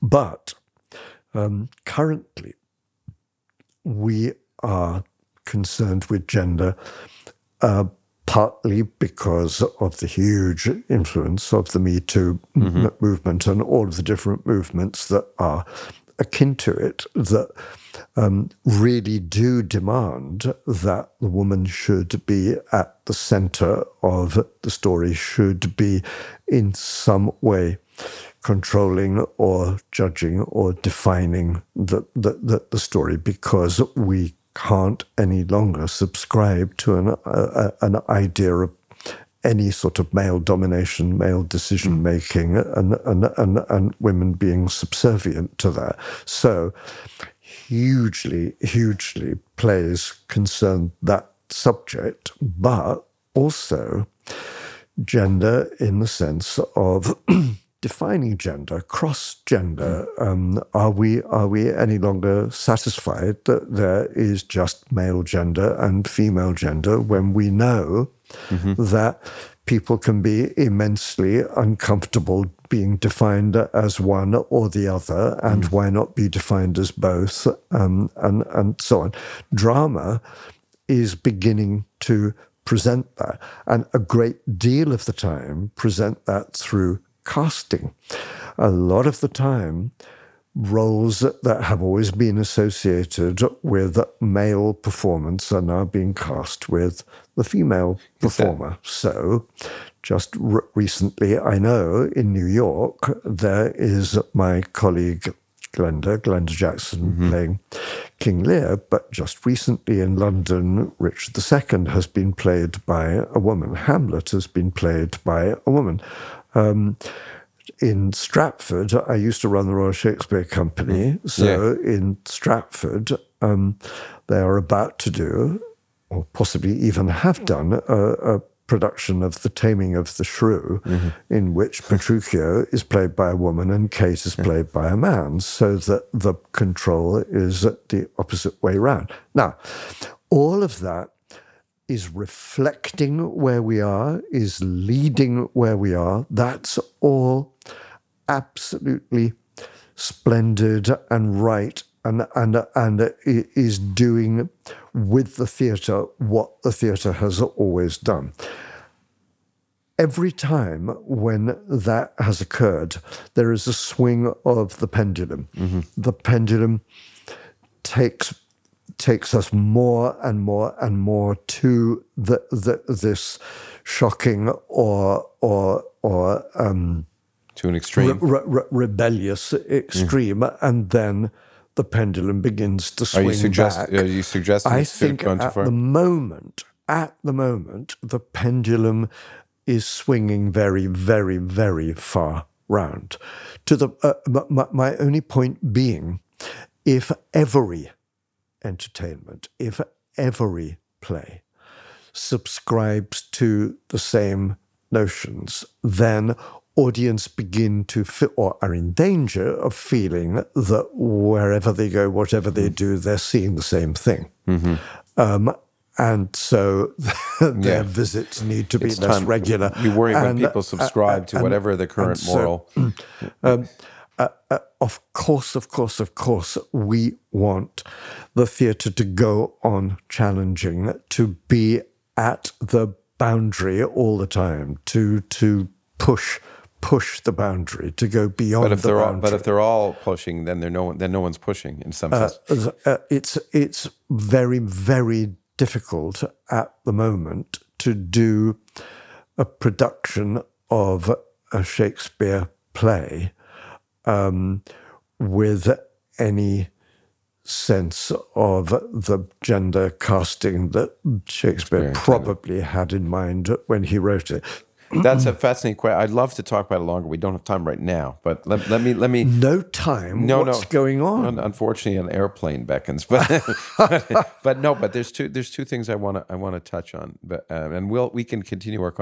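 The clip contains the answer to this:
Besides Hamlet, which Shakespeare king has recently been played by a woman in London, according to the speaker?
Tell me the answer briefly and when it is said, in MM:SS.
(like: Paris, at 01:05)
Richard II, at 01:50.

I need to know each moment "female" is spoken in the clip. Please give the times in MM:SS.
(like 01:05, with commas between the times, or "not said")
01:06, 01:37.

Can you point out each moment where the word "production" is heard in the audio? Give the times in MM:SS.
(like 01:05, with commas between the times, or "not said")
02:08, 04:09.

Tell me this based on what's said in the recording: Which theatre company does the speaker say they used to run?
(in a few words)
Royal Shakespeare Company.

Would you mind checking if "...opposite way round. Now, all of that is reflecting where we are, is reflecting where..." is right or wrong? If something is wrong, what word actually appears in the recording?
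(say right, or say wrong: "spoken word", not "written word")
wrong: "leading", not "reflecting".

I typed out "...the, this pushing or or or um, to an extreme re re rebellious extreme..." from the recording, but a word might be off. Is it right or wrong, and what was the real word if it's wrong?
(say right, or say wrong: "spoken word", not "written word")
wrong: "shocking", not "pushing".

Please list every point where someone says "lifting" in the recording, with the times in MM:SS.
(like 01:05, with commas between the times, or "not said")
not said.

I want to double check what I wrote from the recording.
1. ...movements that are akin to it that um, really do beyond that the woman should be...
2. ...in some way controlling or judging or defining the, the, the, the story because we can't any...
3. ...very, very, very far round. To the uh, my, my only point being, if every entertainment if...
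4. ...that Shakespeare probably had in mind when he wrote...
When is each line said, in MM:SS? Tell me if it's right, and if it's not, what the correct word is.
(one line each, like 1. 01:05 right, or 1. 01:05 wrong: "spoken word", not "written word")
1. 00:14 wrong: "demand", not "beyond"
2. 00:26 right
3. 03:10 right
4. 04:20 right.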